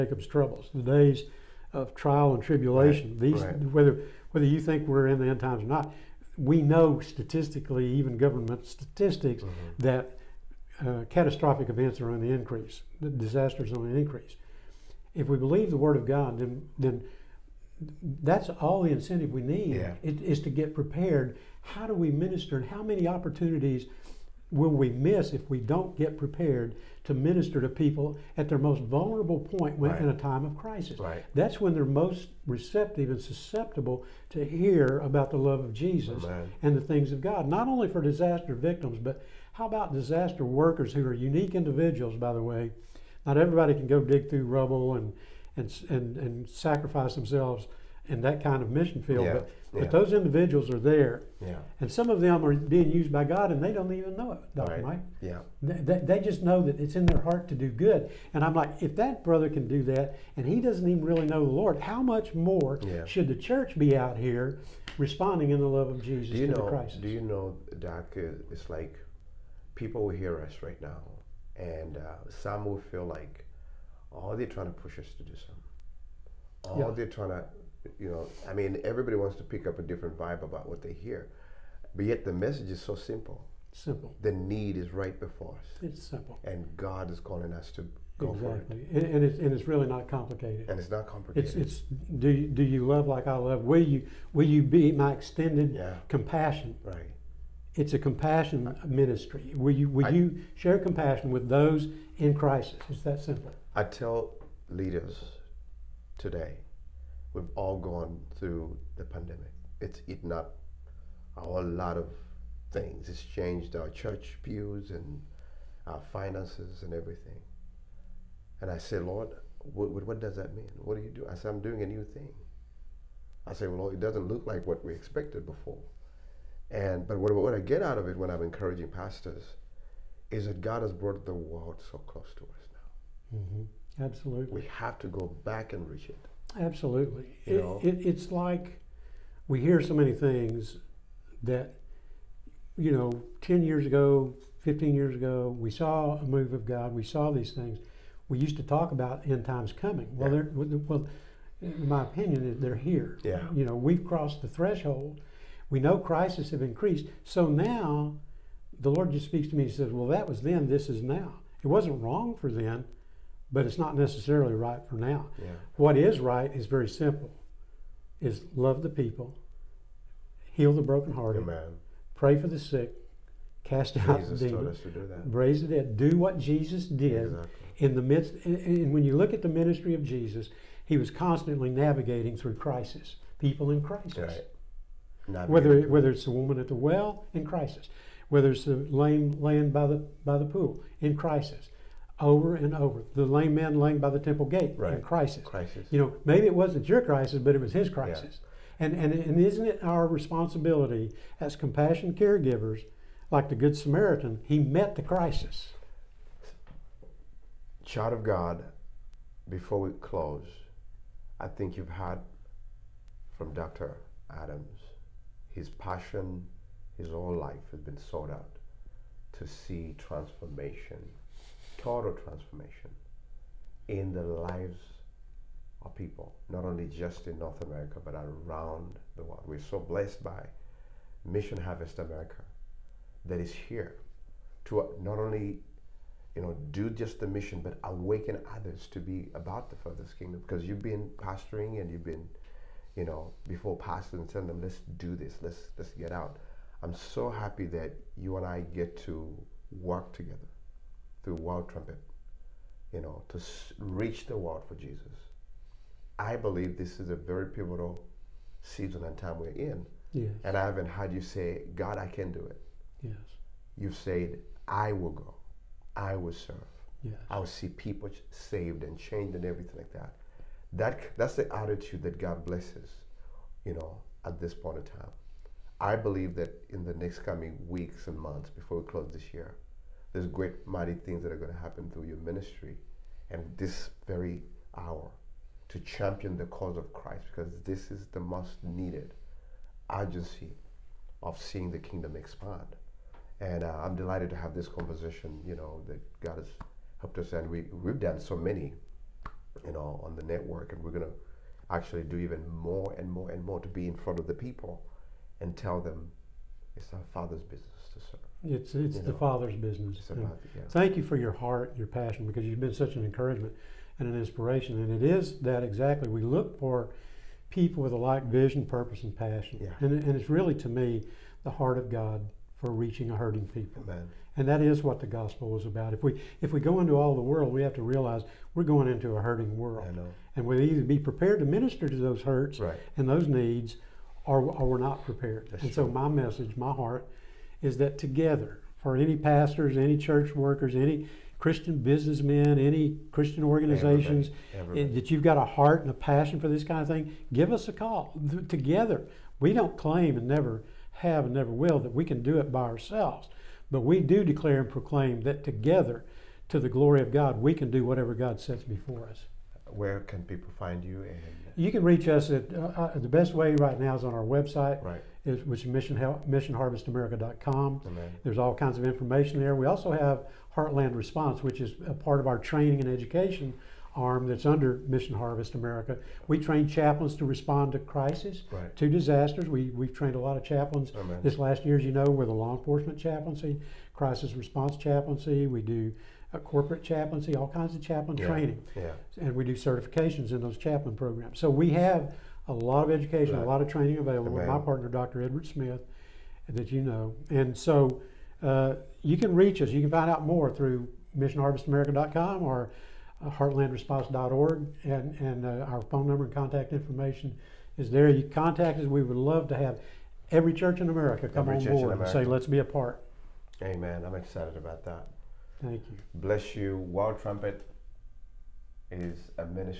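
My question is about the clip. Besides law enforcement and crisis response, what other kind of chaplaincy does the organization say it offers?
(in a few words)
Corporate chaplaincy.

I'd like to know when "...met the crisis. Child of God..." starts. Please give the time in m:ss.
3:24.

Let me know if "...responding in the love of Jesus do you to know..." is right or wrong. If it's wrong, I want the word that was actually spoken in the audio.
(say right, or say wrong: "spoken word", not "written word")
right.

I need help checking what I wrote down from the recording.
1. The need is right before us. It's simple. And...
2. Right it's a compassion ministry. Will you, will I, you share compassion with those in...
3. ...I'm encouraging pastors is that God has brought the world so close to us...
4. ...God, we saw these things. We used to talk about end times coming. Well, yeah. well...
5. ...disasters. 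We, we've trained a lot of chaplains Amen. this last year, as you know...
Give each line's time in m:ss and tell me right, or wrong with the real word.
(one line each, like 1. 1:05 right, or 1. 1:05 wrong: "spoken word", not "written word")
1. 1:24 right
2. 1:36 right
3. 2:08 right
4. 2:26 right
5. 6:18 right.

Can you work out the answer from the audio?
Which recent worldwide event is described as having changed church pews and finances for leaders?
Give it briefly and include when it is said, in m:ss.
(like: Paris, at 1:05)
The pandemic, at 1:49.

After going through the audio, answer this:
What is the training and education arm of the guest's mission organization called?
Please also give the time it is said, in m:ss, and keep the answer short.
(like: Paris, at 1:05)
Heartland Response, at 6:10.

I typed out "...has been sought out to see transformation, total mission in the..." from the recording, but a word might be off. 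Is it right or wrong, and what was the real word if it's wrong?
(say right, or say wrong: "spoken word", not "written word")
wrong: "transformation", not "mission".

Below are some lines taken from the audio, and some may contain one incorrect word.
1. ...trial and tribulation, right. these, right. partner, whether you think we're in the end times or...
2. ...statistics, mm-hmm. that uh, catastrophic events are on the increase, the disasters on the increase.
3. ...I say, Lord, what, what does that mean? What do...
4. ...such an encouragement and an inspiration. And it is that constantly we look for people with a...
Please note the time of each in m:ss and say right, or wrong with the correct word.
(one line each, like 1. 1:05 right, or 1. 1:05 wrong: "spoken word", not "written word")
1. 0:01 wrong: "whether", not "partner"
2. 0:08 right
3. 1:58 right
4. 5:12 wrong: "exactly", not "constantly".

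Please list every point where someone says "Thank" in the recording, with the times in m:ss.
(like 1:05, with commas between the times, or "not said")
5:10, 6:55.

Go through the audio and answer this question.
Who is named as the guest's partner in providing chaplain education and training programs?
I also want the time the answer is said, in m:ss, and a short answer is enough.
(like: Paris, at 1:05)
Dr. Edward Smith, at 6:34.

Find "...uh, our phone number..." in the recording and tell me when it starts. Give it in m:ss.
6:45.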